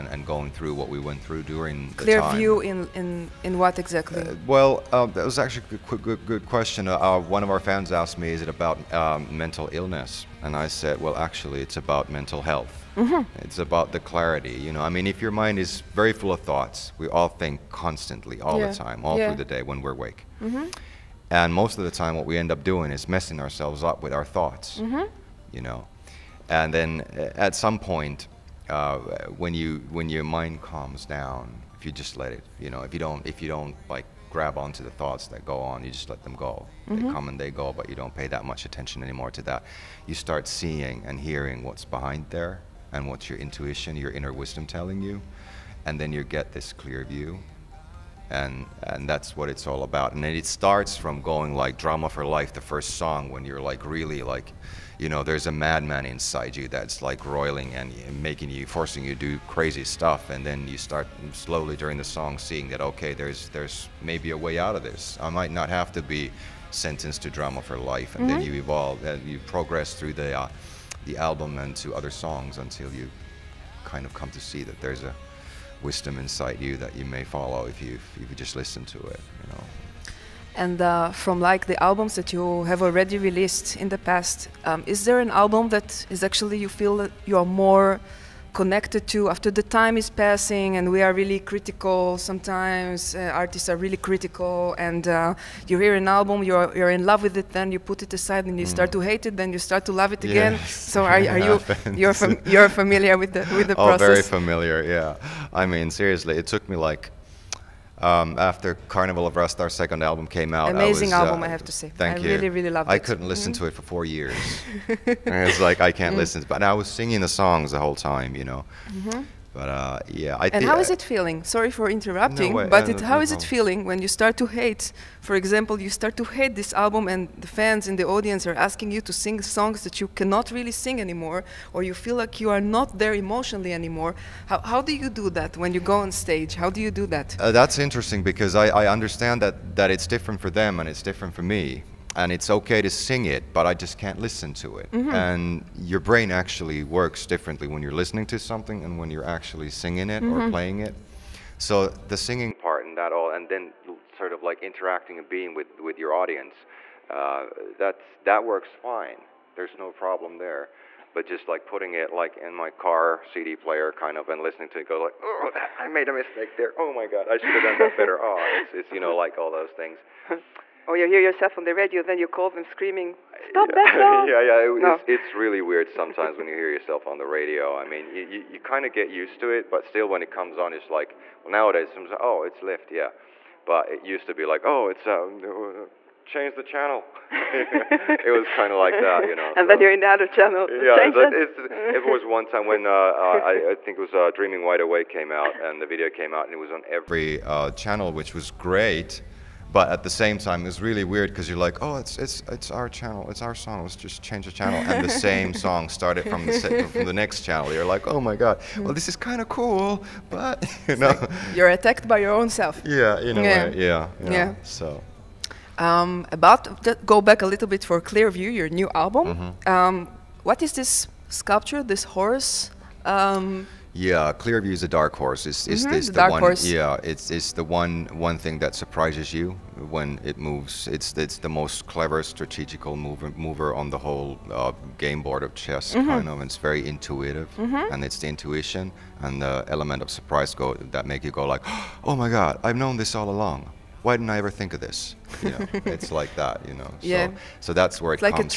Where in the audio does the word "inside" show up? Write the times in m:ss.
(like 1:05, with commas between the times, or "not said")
0:56, 1:16.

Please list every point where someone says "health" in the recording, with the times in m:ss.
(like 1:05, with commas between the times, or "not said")
0:12.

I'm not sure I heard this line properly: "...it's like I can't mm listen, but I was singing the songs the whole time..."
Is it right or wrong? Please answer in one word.
right.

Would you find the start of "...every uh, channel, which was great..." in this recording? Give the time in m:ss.
3:16.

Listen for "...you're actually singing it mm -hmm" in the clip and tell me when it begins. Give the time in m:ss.
2:29.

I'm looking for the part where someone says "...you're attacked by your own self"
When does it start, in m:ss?
3:31.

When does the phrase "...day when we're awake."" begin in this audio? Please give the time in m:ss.
0:19.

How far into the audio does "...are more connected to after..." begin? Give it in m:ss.
1:27.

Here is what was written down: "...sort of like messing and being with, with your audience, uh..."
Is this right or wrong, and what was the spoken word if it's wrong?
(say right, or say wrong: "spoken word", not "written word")
wrong: "interacting", not "messing".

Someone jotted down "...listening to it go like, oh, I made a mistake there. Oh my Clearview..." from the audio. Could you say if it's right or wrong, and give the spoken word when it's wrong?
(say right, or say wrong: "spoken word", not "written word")
wrong: "God", not "Clearview".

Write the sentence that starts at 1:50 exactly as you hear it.
Amazing I was, album, uh, I have to say.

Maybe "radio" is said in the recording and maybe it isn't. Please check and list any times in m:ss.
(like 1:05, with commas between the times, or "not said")
2:51, 2:57.